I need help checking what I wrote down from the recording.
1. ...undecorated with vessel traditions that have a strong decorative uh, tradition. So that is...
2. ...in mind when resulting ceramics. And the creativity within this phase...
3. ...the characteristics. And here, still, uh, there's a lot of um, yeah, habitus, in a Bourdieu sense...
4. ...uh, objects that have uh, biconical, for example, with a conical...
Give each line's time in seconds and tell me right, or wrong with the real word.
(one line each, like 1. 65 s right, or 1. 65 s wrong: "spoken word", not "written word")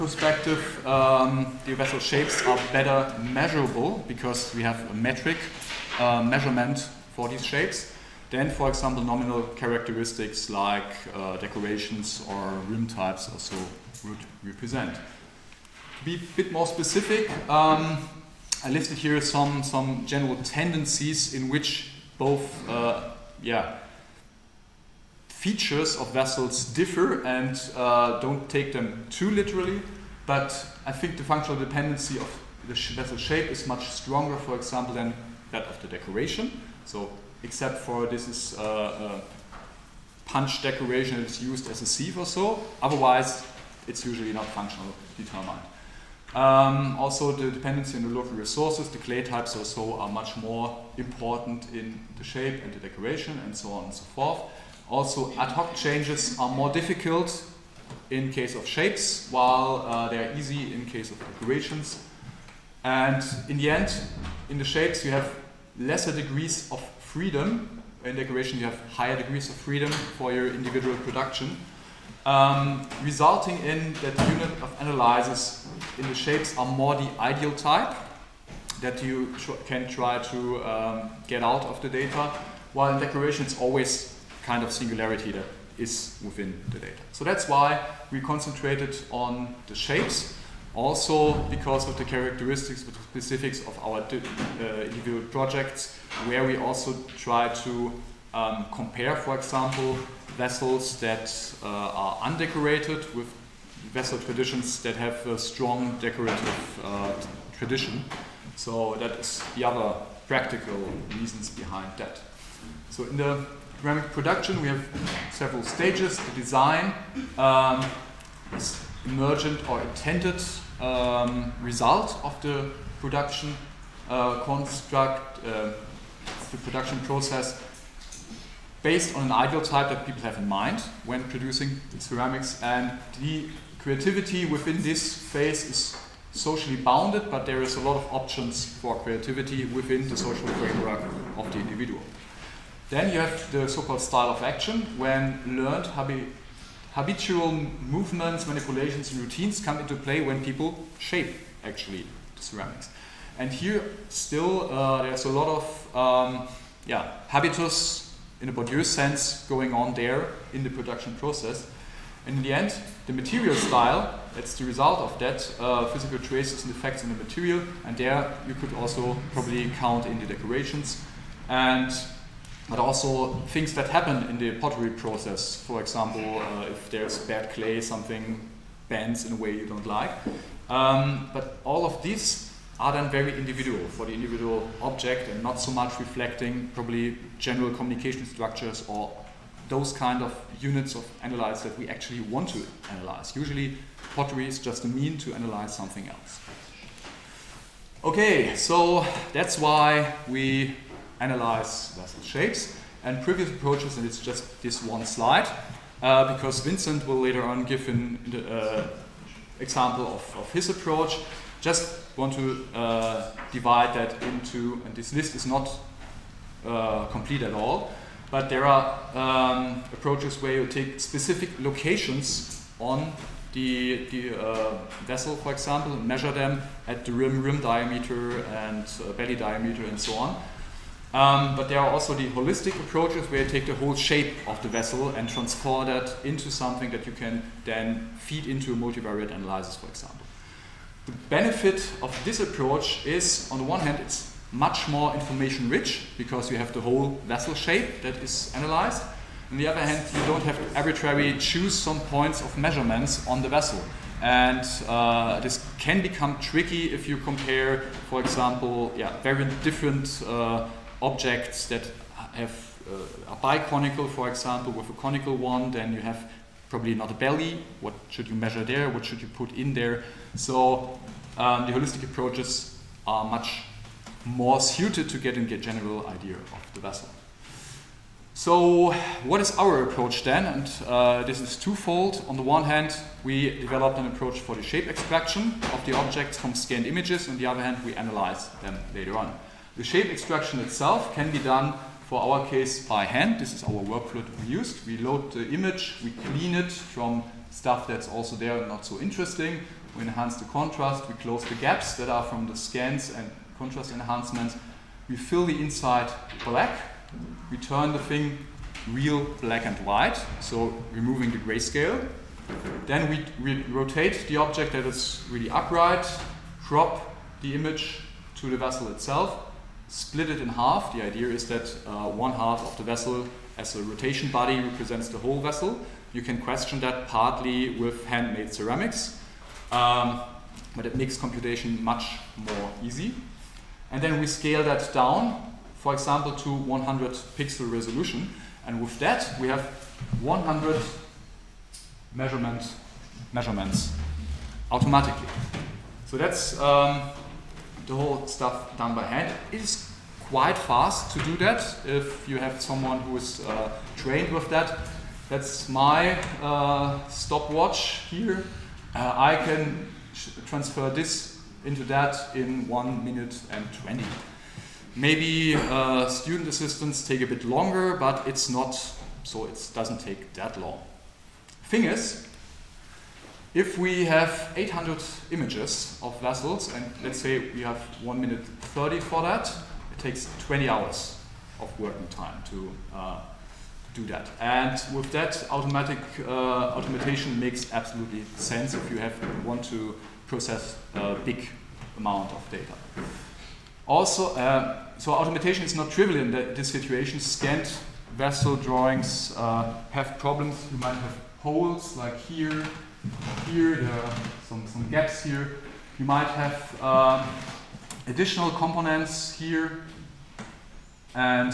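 1. 102 s right
2. 130 s wrong: "producing", not "resulting"
3. 152 s wrong: "ceramics", not "characteristics"
4. 260 s right.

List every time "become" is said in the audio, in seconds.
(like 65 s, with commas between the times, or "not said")
256 s.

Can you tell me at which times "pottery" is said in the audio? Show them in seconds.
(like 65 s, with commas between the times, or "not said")
174 s, 194 s.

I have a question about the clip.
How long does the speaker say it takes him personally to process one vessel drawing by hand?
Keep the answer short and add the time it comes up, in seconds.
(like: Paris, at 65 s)
1 minute 20 seconds, at 362 s.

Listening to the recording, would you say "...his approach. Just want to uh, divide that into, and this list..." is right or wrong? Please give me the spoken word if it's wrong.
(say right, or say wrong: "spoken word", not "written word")
right.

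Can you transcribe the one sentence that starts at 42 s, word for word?
Otherwise, it's usually not functional determined.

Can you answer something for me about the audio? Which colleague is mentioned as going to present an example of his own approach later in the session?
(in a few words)
Vincent.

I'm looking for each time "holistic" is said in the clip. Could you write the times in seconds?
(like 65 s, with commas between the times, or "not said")
232 s, 271 s.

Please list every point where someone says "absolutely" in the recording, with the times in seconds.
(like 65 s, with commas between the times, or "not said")
387 s.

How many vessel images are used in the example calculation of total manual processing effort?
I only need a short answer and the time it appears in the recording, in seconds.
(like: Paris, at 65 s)
800, at 374 s.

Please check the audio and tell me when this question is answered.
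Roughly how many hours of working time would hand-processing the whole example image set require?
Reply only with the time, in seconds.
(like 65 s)
380 s.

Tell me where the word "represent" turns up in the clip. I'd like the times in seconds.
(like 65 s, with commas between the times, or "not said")
14 s, 324 s.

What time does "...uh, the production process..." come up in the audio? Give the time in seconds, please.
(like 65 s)
125 s.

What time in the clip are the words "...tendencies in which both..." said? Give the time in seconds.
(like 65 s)
20 s.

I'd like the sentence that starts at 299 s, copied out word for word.
We enhance the contrast, we close the gaps that are from the scans and contrast enhancements.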